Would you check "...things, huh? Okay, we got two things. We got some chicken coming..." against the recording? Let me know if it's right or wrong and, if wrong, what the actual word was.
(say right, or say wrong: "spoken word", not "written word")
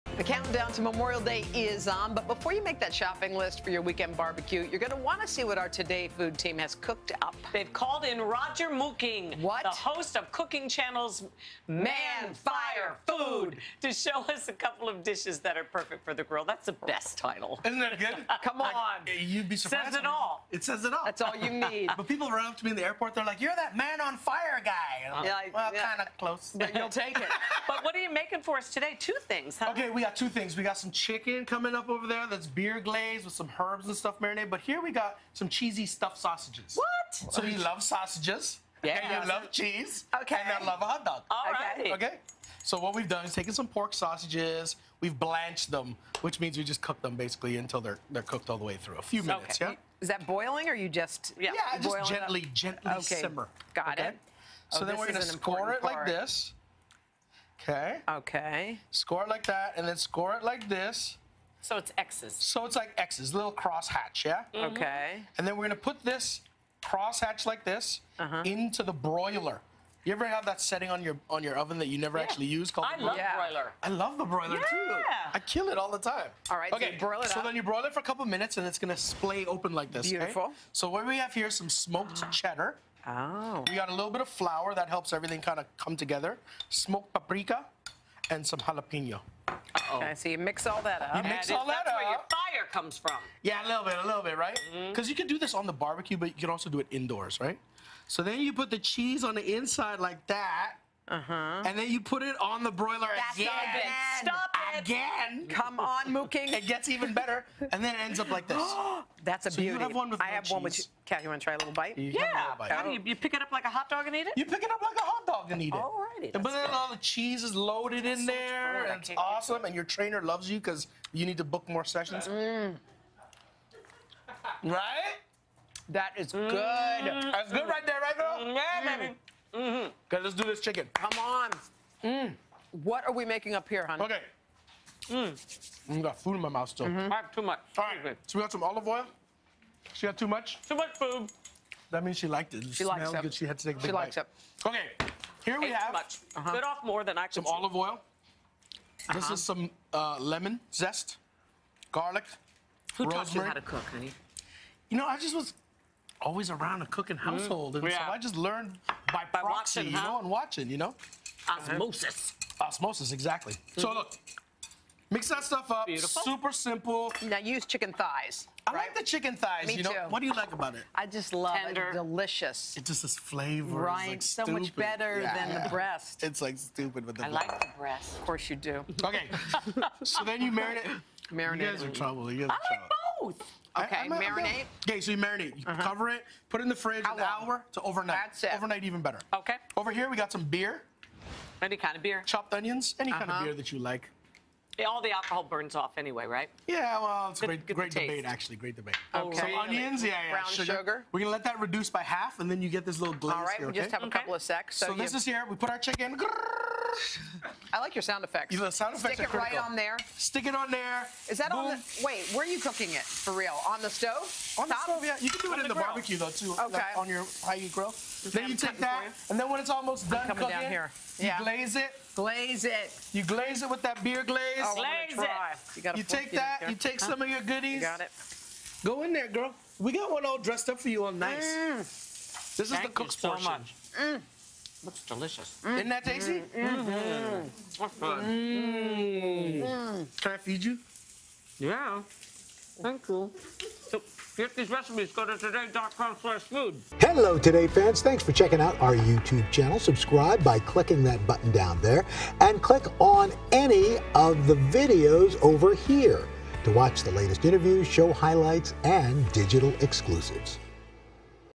right.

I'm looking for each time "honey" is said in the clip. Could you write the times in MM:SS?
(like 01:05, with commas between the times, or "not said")
02:13, 02:33.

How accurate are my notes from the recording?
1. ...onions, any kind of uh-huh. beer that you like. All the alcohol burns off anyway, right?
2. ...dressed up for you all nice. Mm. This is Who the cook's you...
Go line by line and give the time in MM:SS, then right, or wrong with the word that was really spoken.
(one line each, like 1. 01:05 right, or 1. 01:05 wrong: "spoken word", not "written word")
1. 03:12 right
2. 03:50 wrong: "Thank", not "Who".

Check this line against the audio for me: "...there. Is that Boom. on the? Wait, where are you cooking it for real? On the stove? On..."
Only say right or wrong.
right.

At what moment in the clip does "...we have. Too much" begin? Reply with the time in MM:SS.
02:25.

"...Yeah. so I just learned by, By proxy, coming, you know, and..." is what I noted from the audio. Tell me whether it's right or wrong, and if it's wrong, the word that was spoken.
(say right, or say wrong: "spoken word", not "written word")
wrong: "watching", not "coming".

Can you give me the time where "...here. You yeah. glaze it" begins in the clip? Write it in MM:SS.
03:40.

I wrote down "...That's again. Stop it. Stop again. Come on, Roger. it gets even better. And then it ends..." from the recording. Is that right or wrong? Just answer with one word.
wrong.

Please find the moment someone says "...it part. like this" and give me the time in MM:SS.
00:55.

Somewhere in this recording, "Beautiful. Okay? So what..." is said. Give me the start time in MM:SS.
01:20.